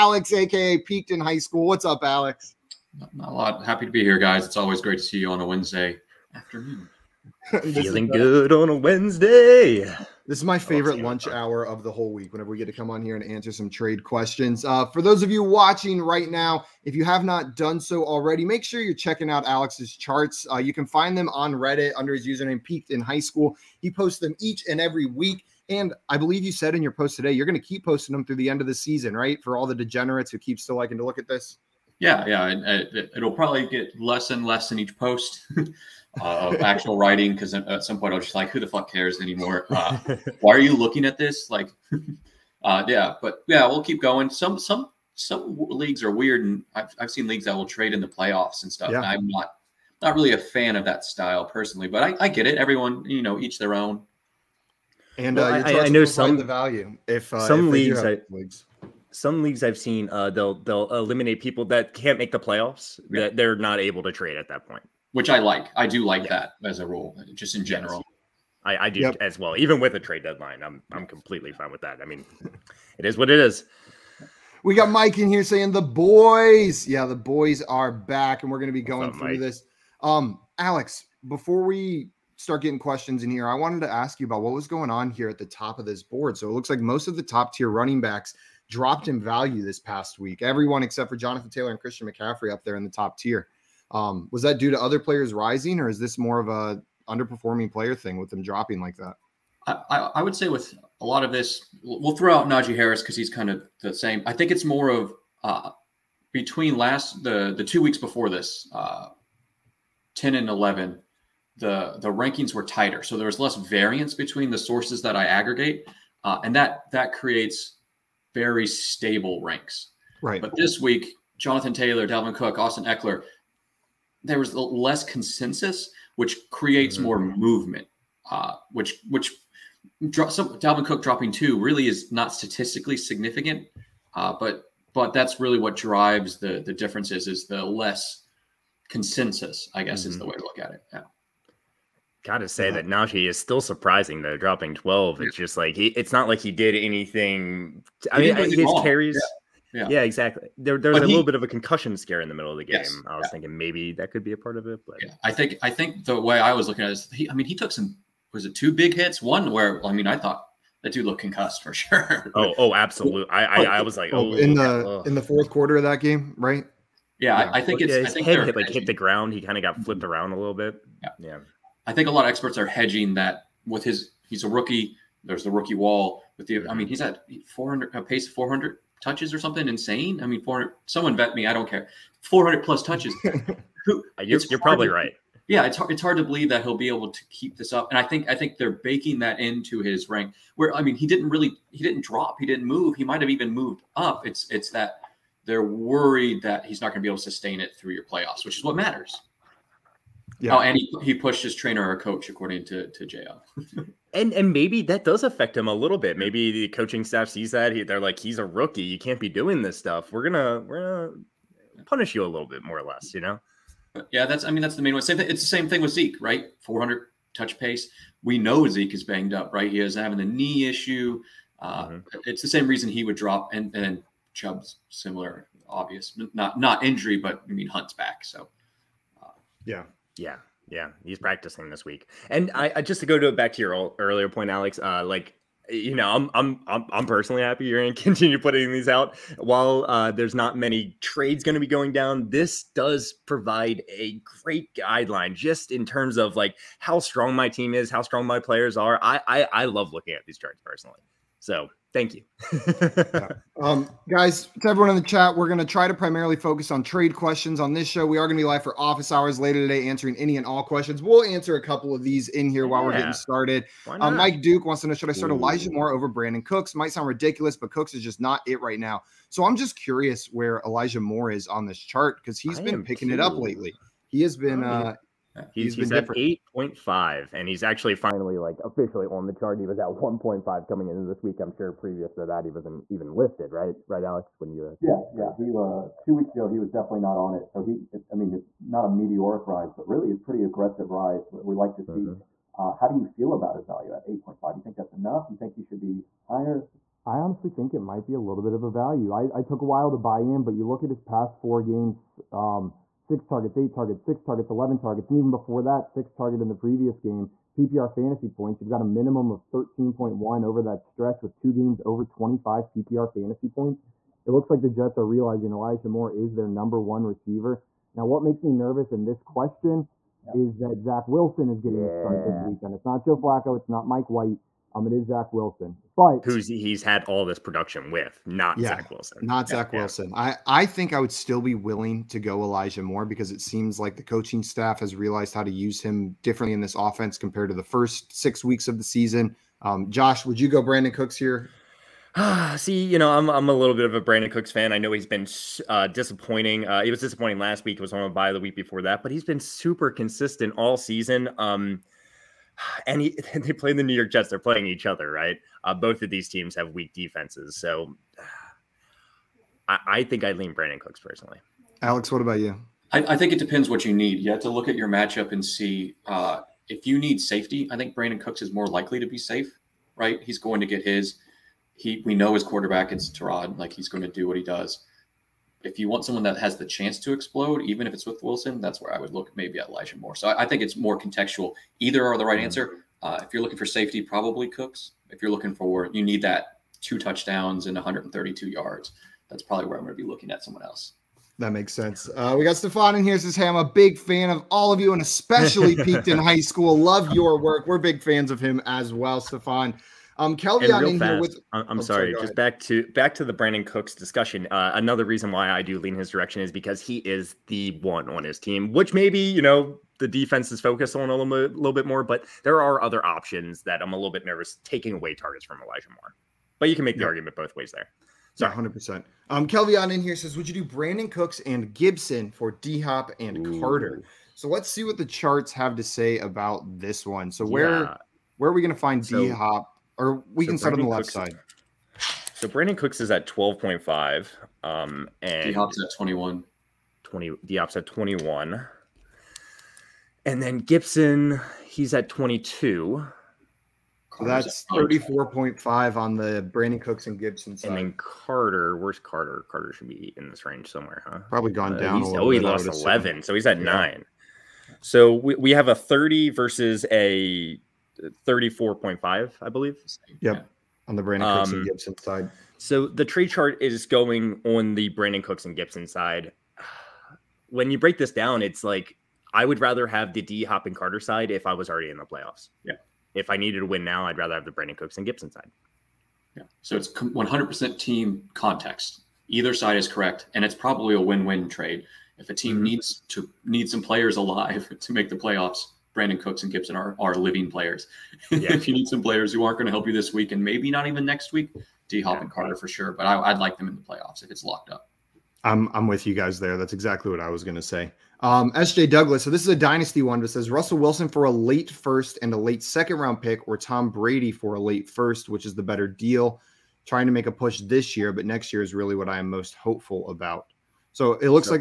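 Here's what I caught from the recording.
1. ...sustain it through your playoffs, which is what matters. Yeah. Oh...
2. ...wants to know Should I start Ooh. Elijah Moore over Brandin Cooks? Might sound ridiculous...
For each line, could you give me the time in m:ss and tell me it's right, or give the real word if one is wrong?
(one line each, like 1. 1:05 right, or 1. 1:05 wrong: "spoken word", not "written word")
1. 3:17 right
2. 4:24 right.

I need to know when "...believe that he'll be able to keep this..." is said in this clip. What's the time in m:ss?
3:06.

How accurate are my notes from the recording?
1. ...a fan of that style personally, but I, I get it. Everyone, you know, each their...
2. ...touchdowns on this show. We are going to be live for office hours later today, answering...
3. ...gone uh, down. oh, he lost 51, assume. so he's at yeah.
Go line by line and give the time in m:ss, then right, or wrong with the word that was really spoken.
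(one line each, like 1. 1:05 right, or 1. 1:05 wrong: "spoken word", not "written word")
1. 0:50 right
2. 4:17 wrong: "questions", not "touchdowns"
3. 7:31 wrong: "11", not "51".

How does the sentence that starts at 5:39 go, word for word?
Um, Josh, would you go Brandin Cooks here?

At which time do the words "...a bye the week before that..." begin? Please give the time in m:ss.
5:48.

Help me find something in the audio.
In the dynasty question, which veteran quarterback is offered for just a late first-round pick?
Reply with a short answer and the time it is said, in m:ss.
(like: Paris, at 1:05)
Tom Brady, at 8:23.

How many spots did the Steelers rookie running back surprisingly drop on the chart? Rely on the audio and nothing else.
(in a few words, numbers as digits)
12.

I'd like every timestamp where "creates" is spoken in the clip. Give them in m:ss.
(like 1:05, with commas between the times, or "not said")
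1:57, 2:06.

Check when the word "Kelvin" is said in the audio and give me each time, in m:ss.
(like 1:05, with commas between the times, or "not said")
6:40, 6:59.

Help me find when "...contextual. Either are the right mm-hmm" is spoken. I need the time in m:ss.
6:20.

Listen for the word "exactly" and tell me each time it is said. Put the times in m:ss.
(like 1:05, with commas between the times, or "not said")
2:30, 8:16.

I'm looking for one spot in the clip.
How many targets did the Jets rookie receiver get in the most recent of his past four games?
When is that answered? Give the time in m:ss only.
5:04.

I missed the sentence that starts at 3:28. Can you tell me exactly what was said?
You can't be doing this stuff.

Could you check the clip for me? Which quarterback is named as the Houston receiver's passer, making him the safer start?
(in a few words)
Tyrod.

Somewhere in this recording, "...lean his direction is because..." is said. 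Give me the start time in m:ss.
6:45.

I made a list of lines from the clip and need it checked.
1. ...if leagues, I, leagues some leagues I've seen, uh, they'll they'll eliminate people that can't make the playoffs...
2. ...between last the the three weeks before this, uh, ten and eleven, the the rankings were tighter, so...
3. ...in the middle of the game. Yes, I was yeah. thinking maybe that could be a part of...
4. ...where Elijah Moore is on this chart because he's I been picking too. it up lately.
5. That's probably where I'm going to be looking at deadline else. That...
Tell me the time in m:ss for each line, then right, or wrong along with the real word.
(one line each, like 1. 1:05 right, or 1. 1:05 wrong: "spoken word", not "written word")
1. 0:57 right
2. 1:46 wrong: "two", not "three"
3. 2:32 right
4. 4:30 right
5. 6:29 wrong: "someone", not "deadline".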